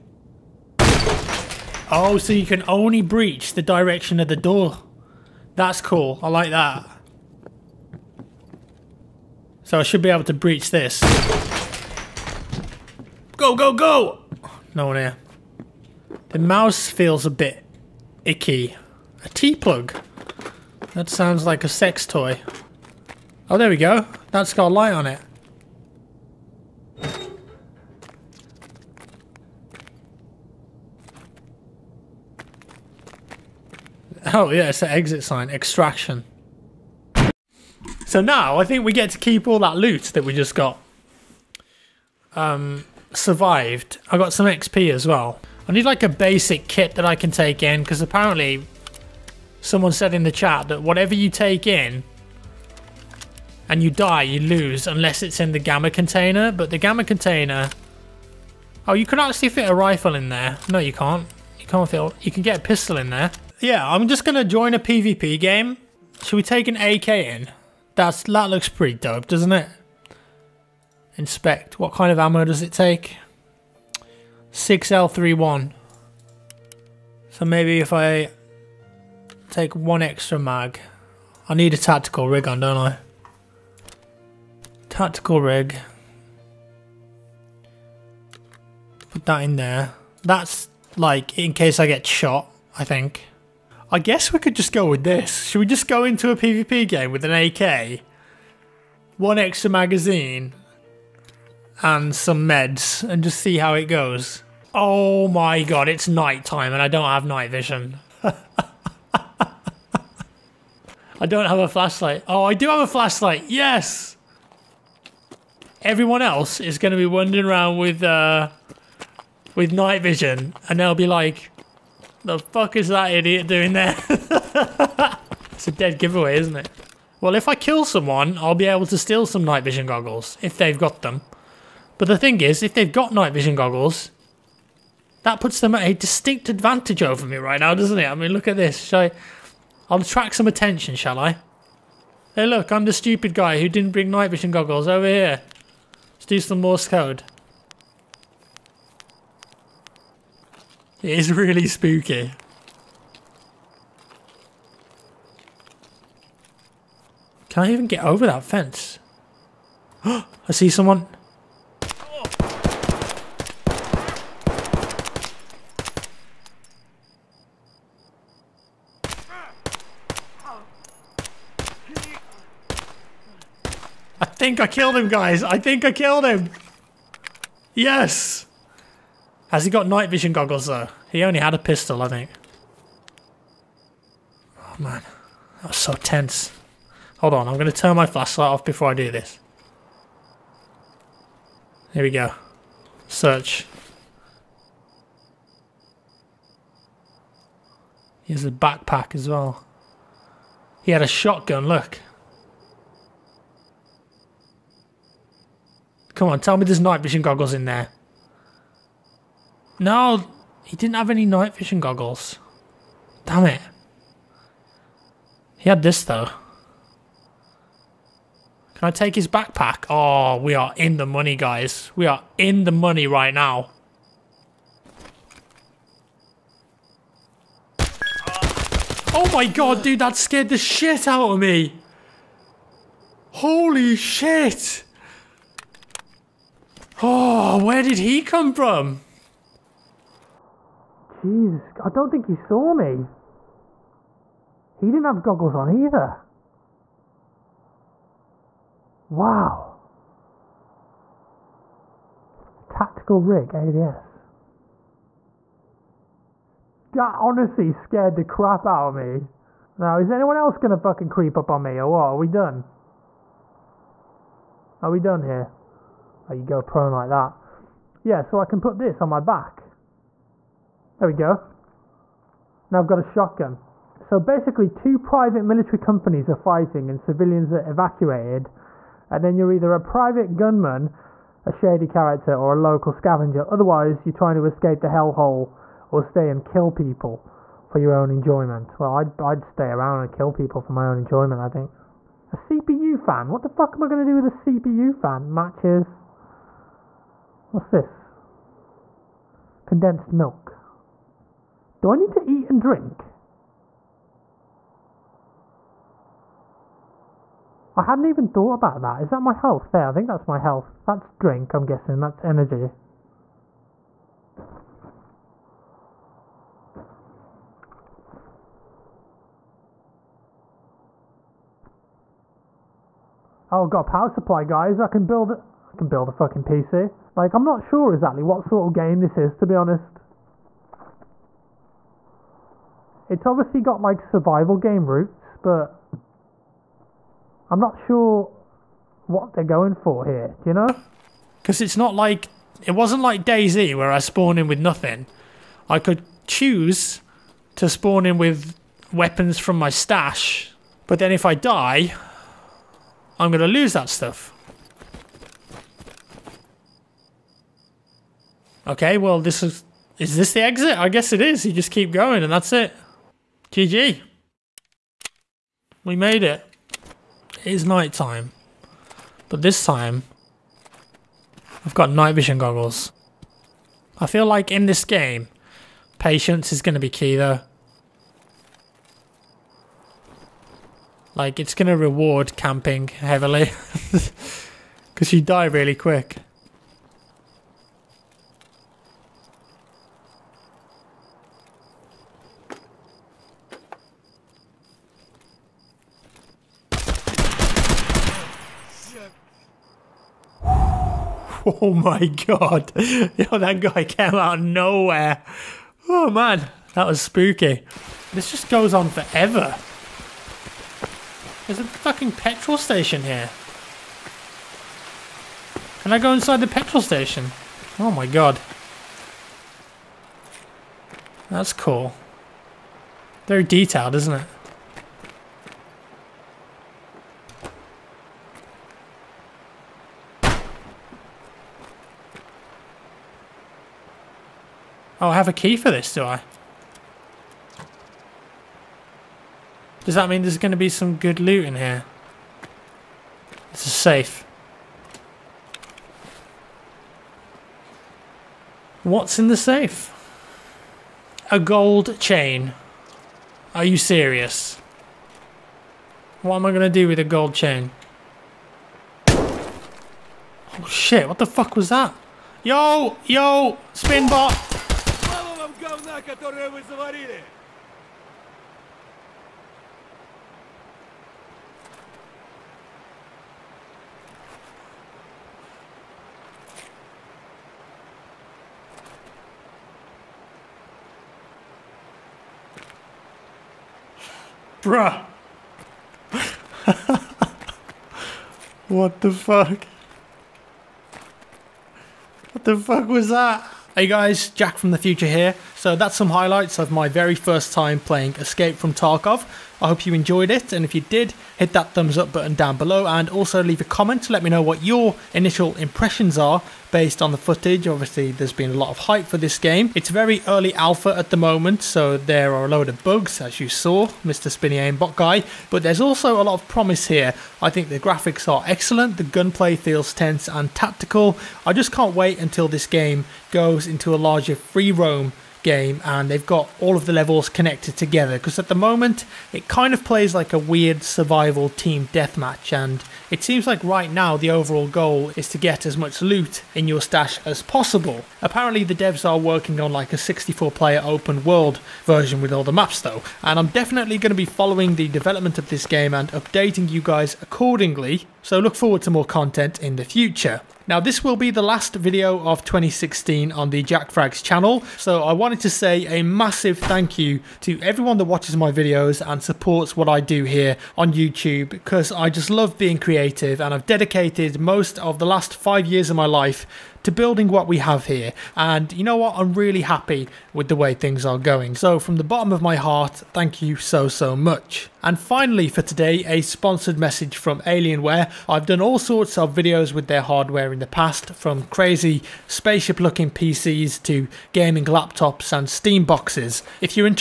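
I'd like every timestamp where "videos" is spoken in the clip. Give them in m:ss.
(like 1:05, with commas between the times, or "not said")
9:11, 9:18, 9:39.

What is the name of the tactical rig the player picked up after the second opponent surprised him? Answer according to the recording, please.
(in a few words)
AVS.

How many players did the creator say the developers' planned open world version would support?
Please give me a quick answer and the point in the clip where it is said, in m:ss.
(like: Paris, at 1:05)
64, at 8:59.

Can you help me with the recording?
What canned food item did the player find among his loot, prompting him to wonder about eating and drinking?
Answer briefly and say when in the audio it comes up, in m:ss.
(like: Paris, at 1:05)
Condensed milk, at 4:59.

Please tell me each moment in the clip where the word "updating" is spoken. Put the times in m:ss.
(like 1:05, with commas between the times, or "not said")
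9:06.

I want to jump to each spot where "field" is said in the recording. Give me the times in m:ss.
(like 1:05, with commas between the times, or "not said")
not said.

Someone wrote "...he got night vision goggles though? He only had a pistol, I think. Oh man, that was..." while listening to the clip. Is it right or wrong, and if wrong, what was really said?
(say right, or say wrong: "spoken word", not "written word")
right.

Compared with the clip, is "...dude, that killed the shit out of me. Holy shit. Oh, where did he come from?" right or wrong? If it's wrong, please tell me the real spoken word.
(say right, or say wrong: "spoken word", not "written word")
wrong: "scared", not "killed".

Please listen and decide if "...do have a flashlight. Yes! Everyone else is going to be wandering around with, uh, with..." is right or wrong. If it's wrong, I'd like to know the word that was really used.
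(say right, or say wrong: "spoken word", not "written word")
right.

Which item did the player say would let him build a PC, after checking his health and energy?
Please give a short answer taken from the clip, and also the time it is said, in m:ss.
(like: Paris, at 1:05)
Power supply, at 5:23.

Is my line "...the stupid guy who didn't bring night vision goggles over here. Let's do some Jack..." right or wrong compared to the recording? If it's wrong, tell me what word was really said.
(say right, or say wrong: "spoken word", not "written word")
wrong: "Morse", not "Jack".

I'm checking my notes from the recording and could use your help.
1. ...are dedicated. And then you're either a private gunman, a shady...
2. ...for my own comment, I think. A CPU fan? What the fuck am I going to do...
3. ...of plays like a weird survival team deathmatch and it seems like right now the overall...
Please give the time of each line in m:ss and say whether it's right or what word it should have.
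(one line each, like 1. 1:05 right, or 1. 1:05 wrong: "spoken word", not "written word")
1. 4:37 wrong: "evacuated", not "dedicated"
2. 4:50 wrong: "enjoyment", not "comment"
3. 8:49 right.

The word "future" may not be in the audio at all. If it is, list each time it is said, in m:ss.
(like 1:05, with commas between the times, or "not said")
8:14, 9:09.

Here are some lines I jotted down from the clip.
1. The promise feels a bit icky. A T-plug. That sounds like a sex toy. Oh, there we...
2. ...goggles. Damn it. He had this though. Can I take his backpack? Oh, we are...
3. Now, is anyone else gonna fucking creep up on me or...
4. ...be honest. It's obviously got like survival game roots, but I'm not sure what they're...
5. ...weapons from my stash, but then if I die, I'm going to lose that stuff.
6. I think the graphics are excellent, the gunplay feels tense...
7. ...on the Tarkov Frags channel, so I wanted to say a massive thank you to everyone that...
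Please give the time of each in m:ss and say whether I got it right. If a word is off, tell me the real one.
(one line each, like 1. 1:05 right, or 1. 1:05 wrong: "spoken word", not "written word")
1. 0:16 wrong: "mouse", not "promise"
2. 3:31 right
3. 4:19 right
4. 5:29 right
5. 5:48 right
6. 8:37 right
7. 9:13 wrong: "Jack", not "Tarkov".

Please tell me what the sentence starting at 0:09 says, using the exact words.
So I should be able to breach this.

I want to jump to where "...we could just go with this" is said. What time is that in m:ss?
1:34.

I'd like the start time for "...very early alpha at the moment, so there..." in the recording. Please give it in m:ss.
8:29.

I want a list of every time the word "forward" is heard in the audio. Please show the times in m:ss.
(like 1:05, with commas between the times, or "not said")
9:08.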